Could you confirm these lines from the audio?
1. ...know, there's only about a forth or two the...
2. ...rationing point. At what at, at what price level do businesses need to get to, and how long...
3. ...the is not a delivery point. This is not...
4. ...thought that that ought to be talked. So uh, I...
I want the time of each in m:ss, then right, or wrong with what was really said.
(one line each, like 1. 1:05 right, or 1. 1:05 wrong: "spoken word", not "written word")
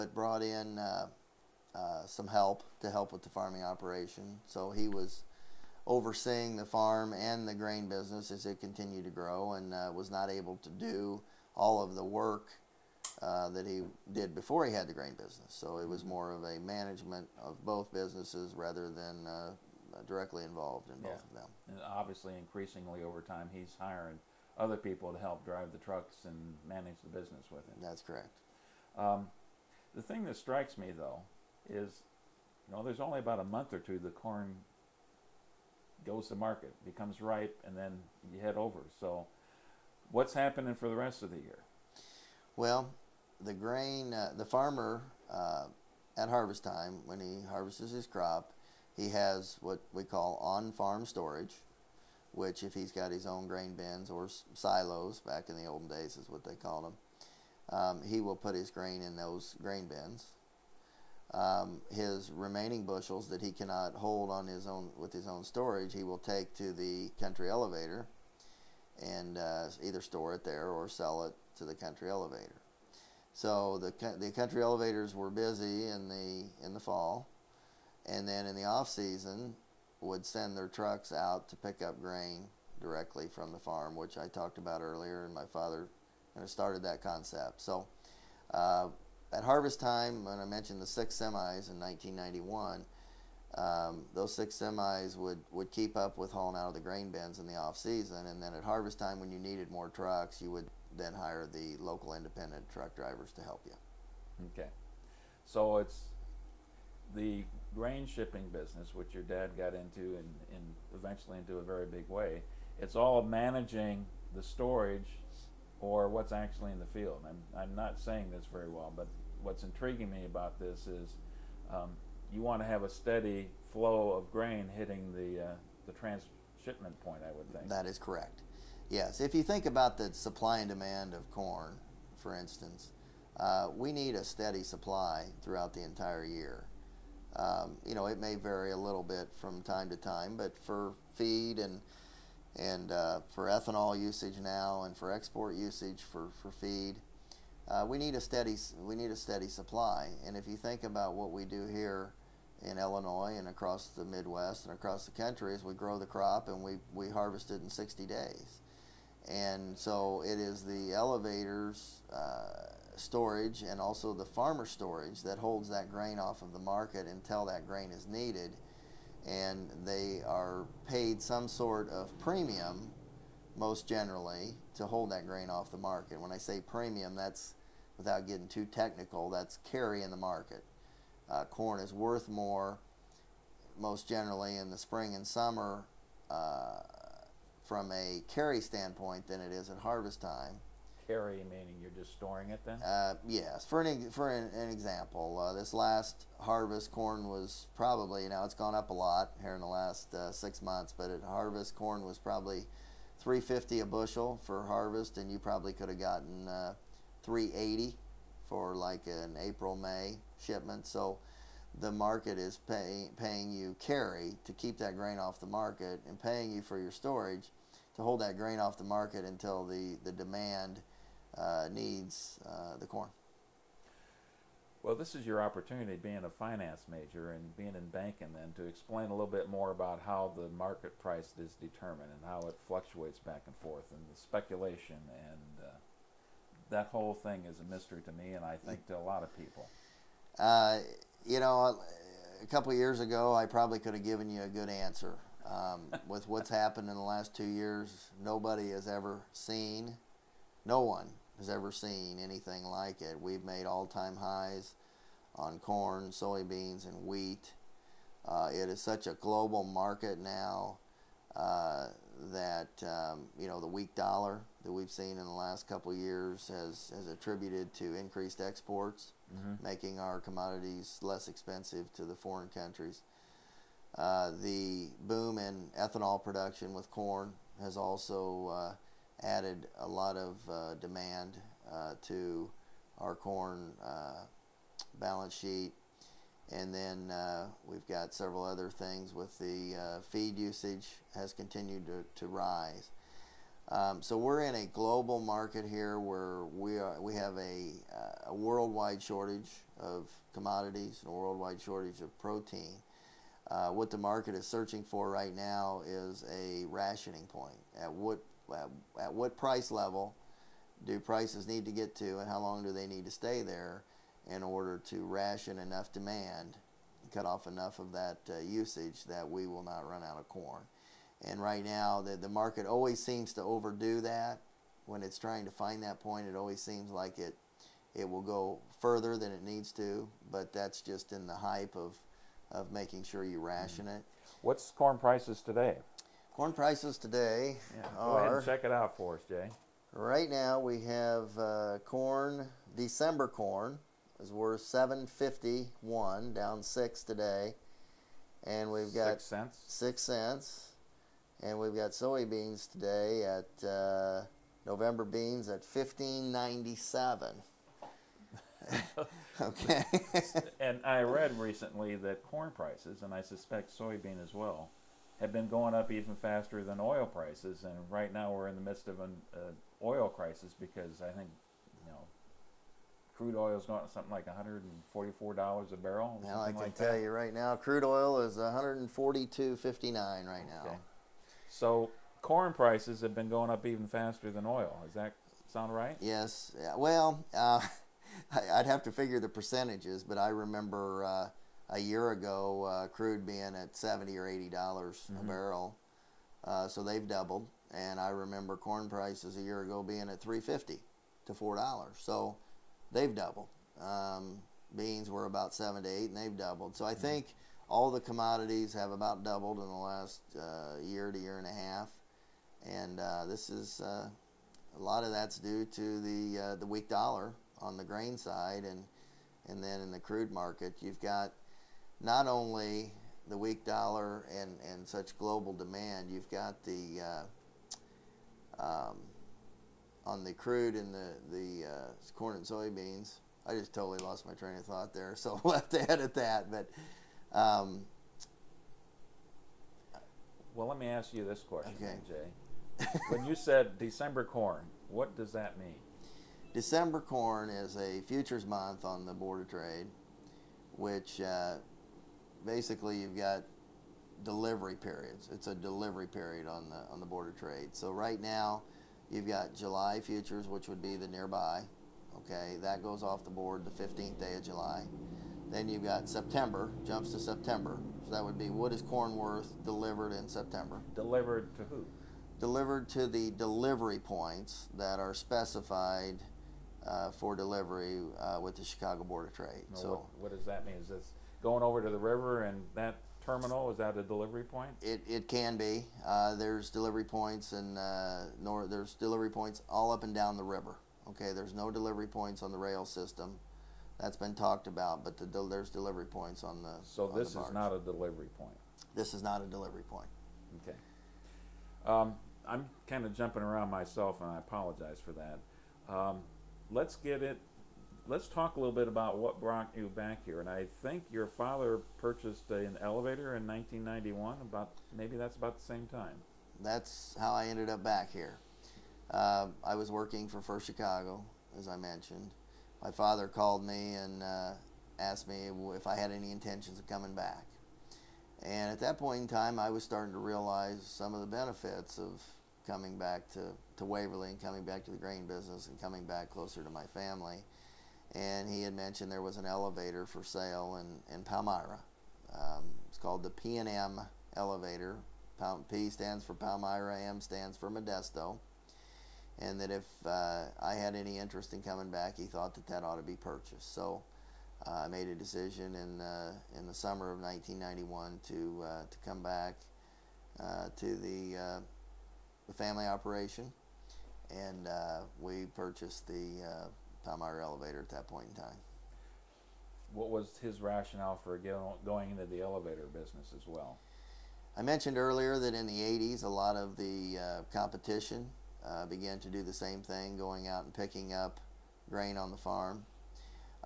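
1. 0:32 wrong: "month", not "forth"
2. 5:06 wrong: "prices", not "businesses"
3. 8:17 right
4. 9:12 wrong: "purchased", not "talked".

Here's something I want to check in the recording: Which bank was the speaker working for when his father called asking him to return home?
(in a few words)
First Chicago.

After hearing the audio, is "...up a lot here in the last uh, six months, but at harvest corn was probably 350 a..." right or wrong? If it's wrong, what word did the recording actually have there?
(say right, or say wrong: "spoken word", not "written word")
right.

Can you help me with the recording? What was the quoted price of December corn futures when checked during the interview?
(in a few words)
7.51.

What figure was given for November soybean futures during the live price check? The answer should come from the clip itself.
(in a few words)
15.97.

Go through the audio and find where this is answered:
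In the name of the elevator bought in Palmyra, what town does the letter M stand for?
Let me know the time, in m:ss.
9:07.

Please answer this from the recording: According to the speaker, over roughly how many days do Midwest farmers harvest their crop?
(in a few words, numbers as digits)
60 days.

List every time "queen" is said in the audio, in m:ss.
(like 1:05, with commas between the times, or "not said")
not said.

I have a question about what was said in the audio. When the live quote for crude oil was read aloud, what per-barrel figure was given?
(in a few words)
142.59.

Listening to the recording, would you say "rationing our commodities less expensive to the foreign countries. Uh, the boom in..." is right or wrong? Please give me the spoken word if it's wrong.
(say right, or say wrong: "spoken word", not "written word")
wrong: "making", not "rationing".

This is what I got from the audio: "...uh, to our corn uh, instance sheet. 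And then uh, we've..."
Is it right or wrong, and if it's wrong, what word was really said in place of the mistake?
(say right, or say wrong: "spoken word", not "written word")
wrong: "balance", not "instance".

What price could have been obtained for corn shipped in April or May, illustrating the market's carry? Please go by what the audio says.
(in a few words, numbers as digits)
3.80.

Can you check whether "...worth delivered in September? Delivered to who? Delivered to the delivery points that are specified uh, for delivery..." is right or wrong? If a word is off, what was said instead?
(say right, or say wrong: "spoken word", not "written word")
right.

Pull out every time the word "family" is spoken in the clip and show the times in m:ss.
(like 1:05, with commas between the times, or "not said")
8:56, 9:22.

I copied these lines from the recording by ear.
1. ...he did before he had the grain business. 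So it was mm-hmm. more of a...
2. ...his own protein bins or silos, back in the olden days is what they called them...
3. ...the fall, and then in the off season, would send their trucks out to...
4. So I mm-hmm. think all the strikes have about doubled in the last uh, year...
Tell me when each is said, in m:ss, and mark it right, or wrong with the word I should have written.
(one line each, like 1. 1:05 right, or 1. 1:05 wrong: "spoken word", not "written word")
1. 0:13 right
2. 0:53 wrong: "grain", not "protein"
3. 1:16 right
4. 6:46 wrong: "commodities", not "strikes".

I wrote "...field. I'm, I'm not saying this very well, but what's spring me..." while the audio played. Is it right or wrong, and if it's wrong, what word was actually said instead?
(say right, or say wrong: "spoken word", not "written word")
wrong: "intriguing", not "spring".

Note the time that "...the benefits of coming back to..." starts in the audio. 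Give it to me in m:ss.
8:51.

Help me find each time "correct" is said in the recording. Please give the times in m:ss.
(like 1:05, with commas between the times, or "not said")
0:28, 2:07.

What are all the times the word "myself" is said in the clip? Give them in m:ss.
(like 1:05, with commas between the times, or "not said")
8:23.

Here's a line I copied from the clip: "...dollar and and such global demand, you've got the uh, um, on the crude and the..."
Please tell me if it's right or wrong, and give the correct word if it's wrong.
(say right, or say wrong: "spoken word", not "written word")
right.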